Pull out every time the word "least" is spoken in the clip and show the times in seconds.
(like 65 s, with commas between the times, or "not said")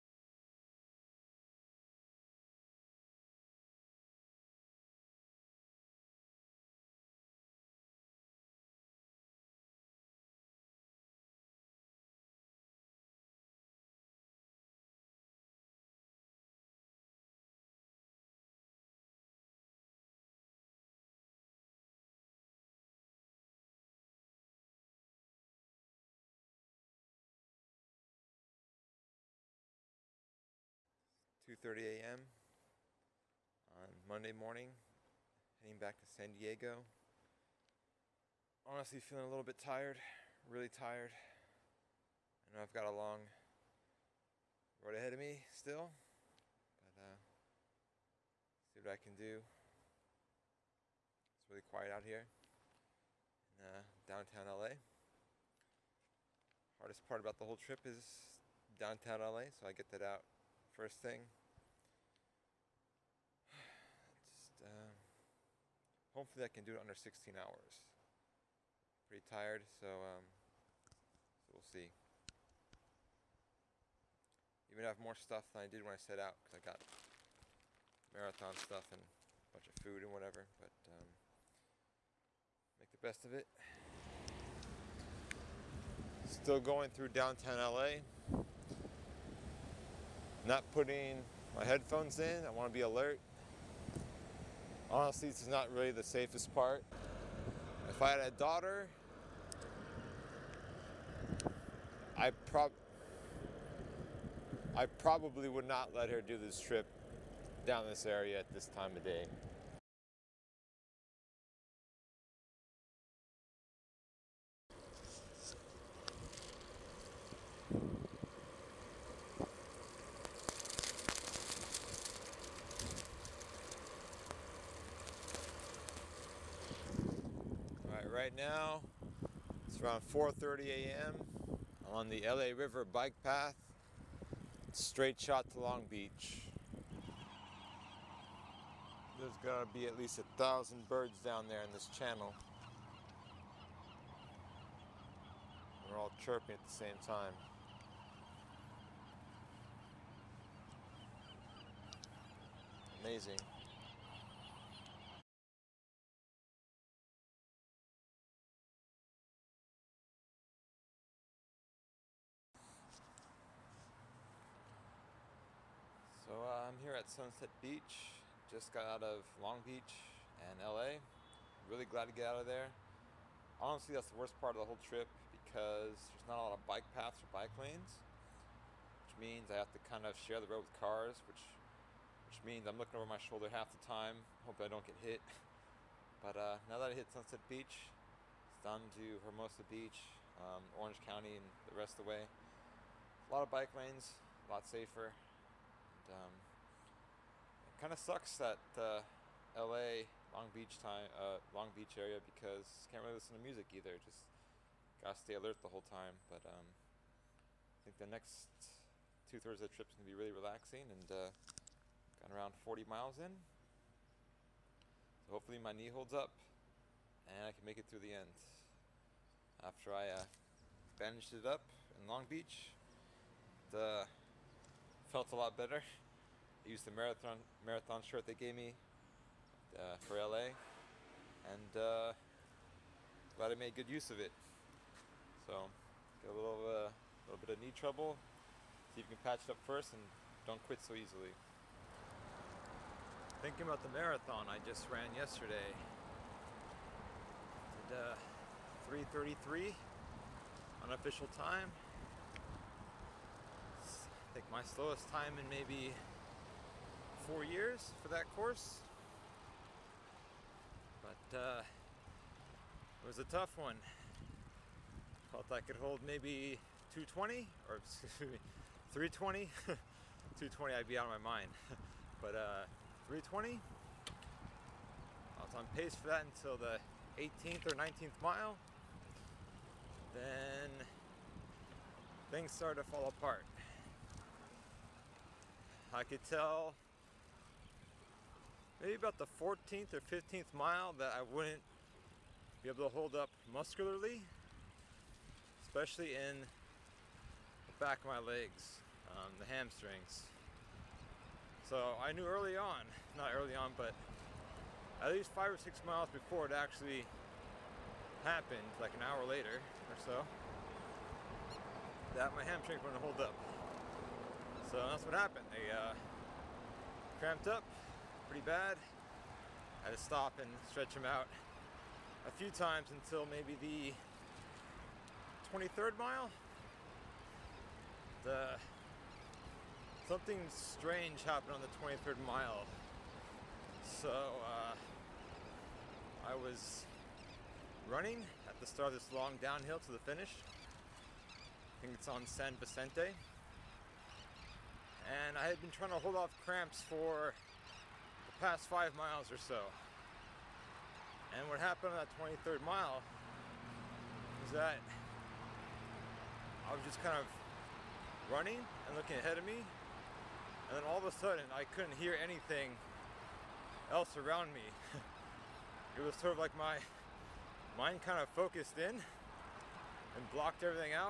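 139 s, 305 s.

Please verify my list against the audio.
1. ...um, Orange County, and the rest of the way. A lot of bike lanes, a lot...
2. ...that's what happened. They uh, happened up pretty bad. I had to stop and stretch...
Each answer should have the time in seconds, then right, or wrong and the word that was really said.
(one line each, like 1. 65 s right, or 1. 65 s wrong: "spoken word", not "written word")
1. 190 s right
2. 314 s wrong: "cramped", not "happened".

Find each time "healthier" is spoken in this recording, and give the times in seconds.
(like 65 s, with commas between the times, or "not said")
not said.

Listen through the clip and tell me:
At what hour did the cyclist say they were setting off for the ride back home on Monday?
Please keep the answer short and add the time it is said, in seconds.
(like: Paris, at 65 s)
2:30 a.m., at 31 s.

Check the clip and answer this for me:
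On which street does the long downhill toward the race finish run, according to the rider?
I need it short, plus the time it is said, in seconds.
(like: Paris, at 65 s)
San Vicente, at 342 s.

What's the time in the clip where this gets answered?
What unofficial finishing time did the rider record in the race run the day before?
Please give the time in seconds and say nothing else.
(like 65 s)
249 s.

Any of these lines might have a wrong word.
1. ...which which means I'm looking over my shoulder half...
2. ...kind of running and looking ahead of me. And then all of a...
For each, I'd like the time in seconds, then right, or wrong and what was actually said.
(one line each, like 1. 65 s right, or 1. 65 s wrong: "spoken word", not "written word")
1. 181 s right
2. 357 s right.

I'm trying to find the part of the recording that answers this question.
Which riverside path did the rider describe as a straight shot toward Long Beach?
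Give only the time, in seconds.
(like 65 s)
132 s.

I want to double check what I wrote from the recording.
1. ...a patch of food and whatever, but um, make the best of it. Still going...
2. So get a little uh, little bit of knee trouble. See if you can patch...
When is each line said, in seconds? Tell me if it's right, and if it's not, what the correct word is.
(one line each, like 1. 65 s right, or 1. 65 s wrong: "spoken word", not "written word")
1. 78 s wrong: "bunch", not "patch"
2. 235 s right.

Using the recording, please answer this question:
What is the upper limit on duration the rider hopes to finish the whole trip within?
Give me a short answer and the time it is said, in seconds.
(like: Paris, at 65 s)
16 hours, at 66 s.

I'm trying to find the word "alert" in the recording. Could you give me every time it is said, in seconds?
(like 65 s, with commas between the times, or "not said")
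92 s, 205 s.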